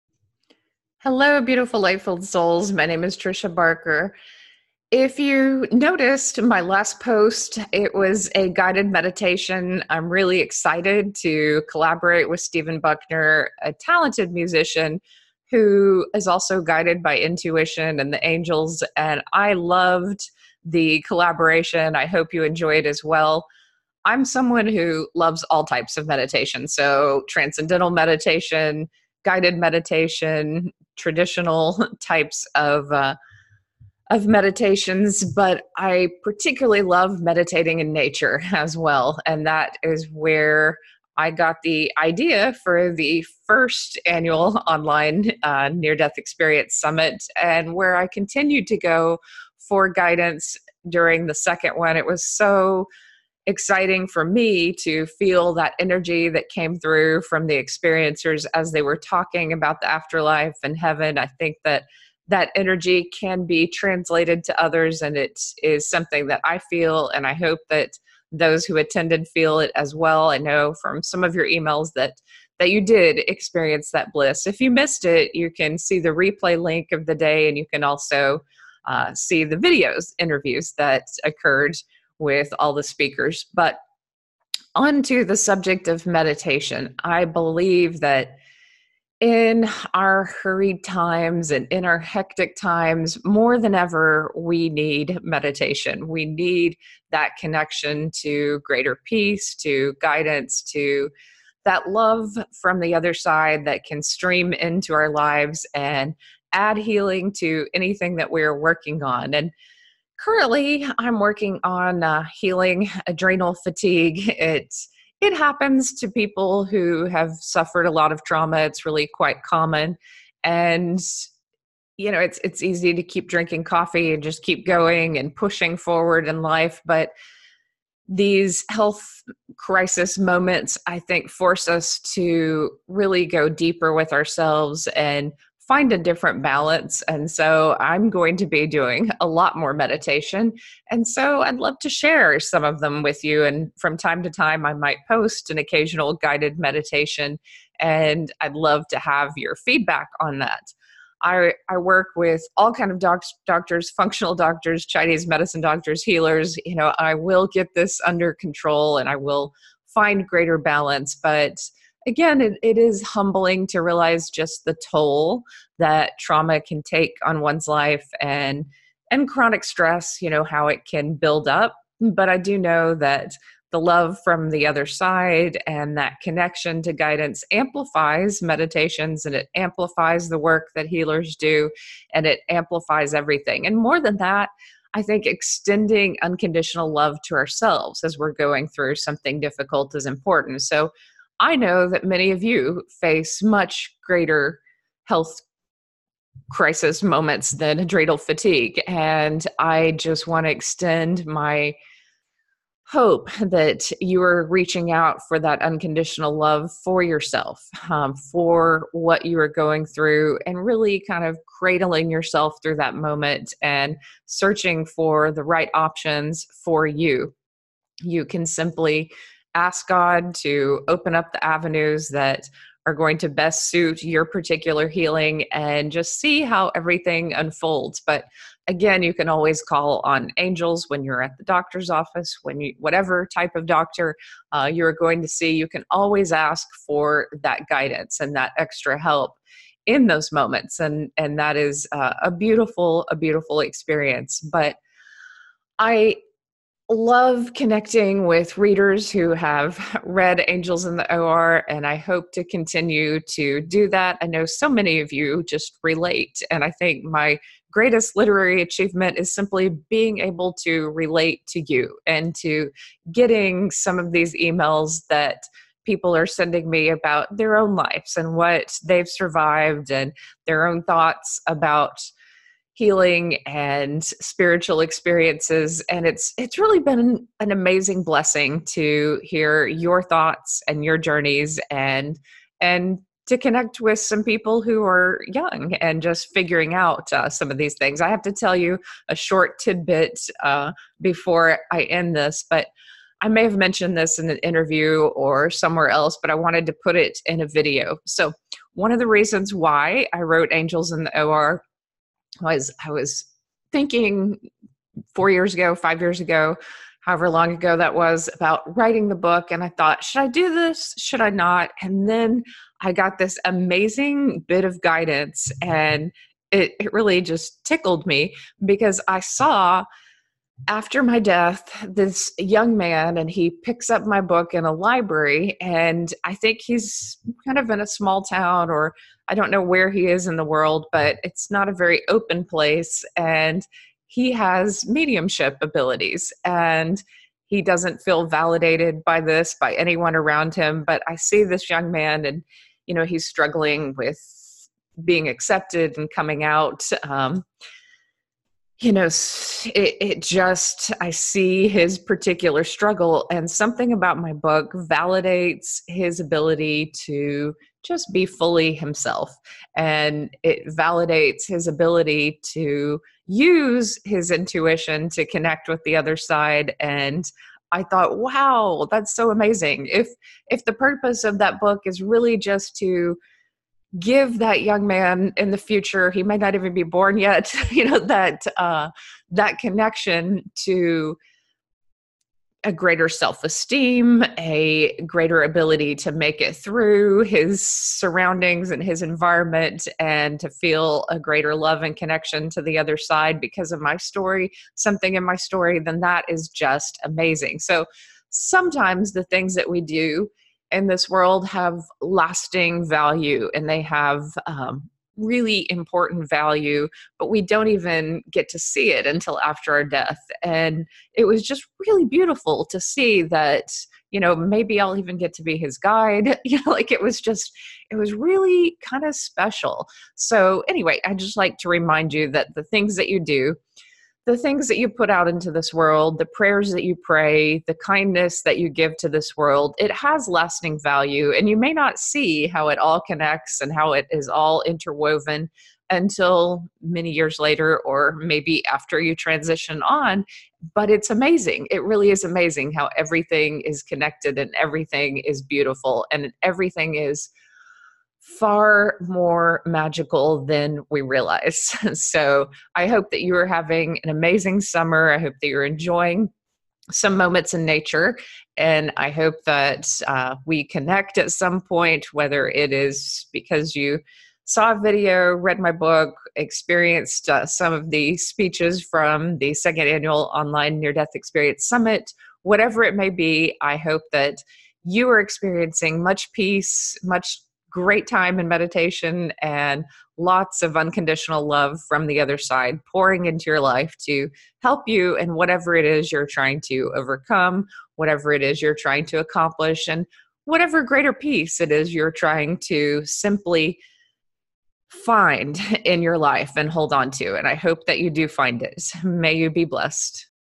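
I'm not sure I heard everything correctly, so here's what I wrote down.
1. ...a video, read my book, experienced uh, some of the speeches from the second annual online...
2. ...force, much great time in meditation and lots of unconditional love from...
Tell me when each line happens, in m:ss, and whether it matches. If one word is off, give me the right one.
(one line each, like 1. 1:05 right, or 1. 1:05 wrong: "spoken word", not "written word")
1. 7:44 right
2. 7:56 wrong: "peace", not "force".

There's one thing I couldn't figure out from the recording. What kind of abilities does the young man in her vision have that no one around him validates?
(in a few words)
Mediumship.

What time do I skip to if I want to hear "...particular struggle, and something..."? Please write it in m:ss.
5:51.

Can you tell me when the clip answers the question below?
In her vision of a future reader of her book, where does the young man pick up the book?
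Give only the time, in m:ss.
5:24.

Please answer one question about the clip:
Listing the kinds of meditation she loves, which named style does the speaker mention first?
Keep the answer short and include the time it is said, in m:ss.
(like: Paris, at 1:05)
Transcendental meditation, at 0:27.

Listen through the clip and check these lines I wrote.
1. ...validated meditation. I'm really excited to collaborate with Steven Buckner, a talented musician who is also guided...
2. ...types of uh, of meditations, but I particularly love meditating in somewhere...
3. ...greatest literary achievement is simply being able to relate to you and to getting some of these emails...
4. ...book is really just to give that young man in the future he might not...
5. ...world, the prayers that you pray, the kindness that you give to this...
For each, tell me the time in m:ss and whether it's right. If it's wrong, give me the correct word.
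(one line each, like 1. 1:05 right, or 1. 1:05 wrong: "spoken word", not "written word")
1. 0:08 wrong: "guided", not "validated"
2. 0:31 wrong: "nature", not "somewhere"
3. 4:17 right
4. 6:11 right
5. 7:05 right.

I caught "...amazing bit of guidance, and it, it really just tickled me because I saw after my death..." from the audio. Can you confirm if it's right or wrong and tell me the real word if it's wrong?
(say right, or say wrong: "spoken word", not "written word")
right.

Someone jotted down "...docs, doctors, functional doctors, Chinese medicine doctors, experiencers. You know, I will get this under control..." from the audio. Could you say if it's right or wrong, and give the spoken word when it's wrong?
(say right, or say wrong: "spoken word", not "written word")
wrong: "healers", not "experiencers".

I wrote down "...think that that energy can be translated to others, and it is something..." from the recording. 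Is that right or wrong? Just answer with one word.
right.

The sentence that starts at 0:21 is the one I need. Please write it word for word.
I hope you enjoy it as well.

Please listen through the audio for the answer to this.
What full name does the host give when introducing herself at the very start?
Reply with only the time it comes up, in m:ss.
0:03.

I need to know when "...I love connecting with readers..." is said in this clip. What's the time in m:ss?
4:05.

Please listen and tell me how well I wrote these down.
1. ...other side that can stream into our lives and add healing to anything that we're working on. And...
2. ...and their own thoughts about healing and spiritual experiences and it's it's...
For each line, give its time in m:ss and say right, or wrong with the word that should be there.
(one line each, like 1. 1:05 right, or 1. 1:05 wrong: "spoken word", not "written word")
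1. 1:42 right
2. 4:29 right.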